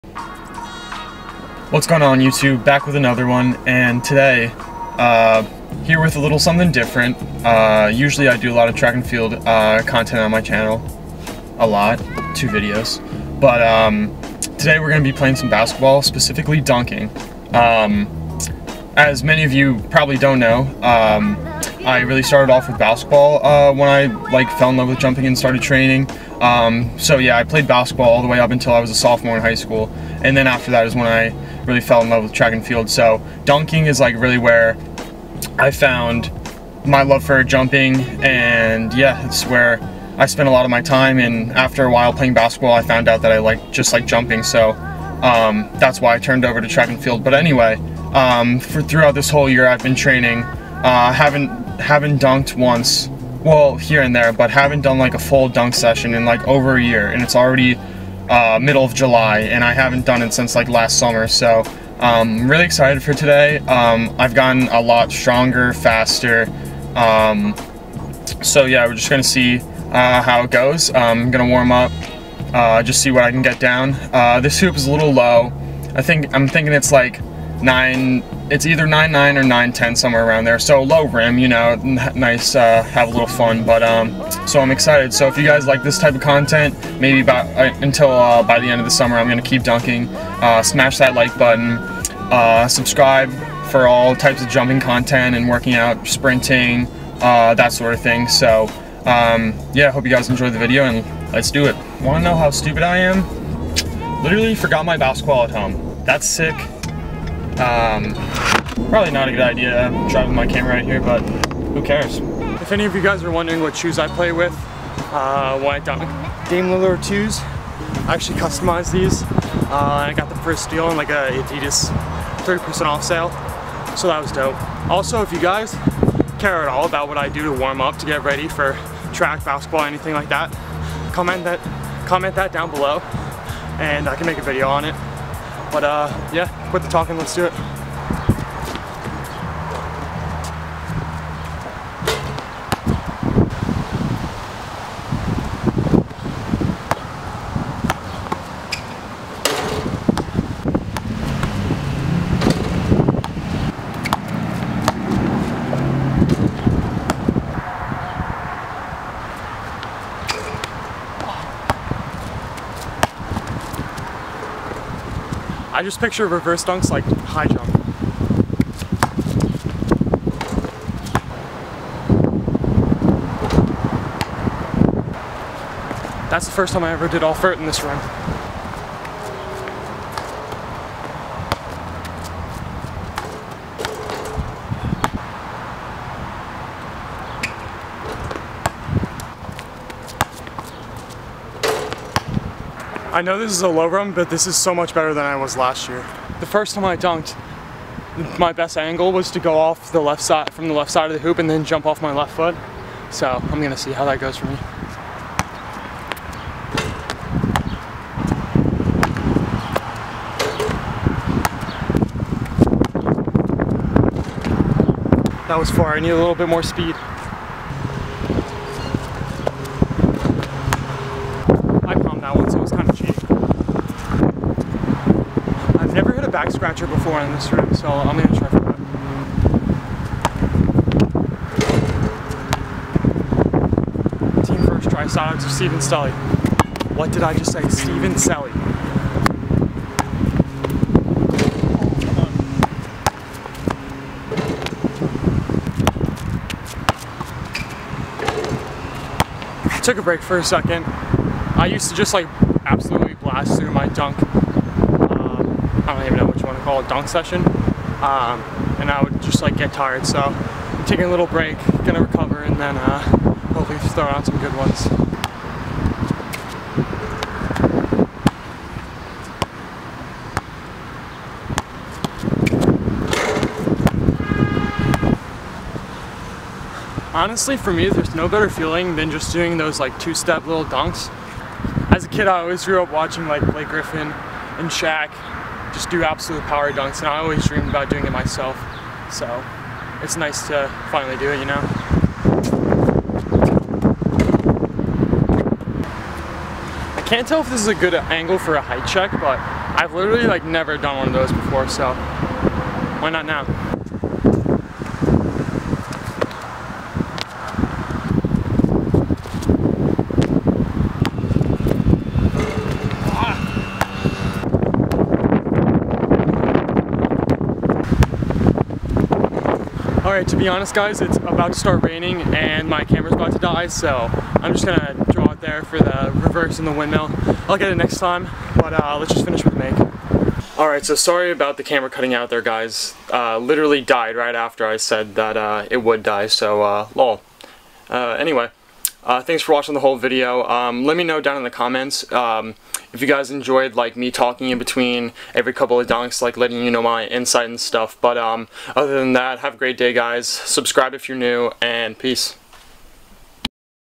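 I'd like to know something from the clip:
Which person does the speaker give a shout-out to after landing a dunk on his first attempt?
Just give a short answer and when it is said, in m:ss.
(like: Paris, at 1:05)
Steven Stelly, at 3:55.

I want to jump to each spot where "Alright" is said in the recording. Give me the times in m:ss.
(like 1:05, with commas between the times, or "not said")
5:20, 5:30.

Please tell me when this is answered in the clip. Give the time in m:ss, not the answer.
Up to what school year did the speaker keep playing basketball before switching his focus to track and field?
0:28.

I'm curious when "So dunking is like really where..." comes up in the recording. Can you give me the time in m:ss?
0:32.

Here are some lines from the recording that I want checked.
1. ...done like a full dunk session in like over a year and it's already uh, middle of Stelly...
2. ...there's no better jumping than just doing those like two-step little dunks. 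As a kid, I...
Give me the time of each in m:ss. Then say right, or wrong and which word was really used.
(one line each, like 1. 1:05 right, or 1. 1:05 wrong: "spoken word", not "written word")
1. 0:54 wrong: "July", not "Stelly"
2. 4:37 wrong: "feeling", not "jumping".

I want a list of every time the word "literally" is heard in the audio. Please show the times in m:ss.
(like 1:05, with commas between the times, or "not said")
1:44, 4:59, 5:33.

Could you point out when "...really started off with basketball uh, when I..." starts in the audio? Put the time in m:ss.
0:22.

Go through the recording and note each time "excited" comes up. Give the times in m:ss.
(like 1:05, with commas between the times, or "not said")
1:02, 1:24.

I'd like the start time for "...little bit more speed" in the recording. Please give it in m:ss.
3:36.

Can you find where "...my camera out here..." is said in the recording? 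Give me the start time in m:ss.
1:50.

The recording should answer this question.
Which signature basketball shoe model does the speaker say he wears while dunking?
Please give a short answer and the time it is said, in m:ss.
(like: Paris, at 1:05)
Dame Lillard 2s, at 1:56.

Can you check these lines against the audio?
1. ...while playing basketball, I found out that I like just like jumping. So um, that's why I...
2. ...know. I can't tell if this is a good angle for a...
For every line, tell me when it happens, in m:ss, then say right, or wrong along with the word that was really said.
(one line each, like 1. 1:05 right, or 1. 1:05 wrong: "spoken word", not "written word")
1. 0:41 right
2. 4:51 right.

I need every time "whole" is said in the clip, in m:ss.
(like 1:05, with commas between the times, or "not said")
0:49, 5:39.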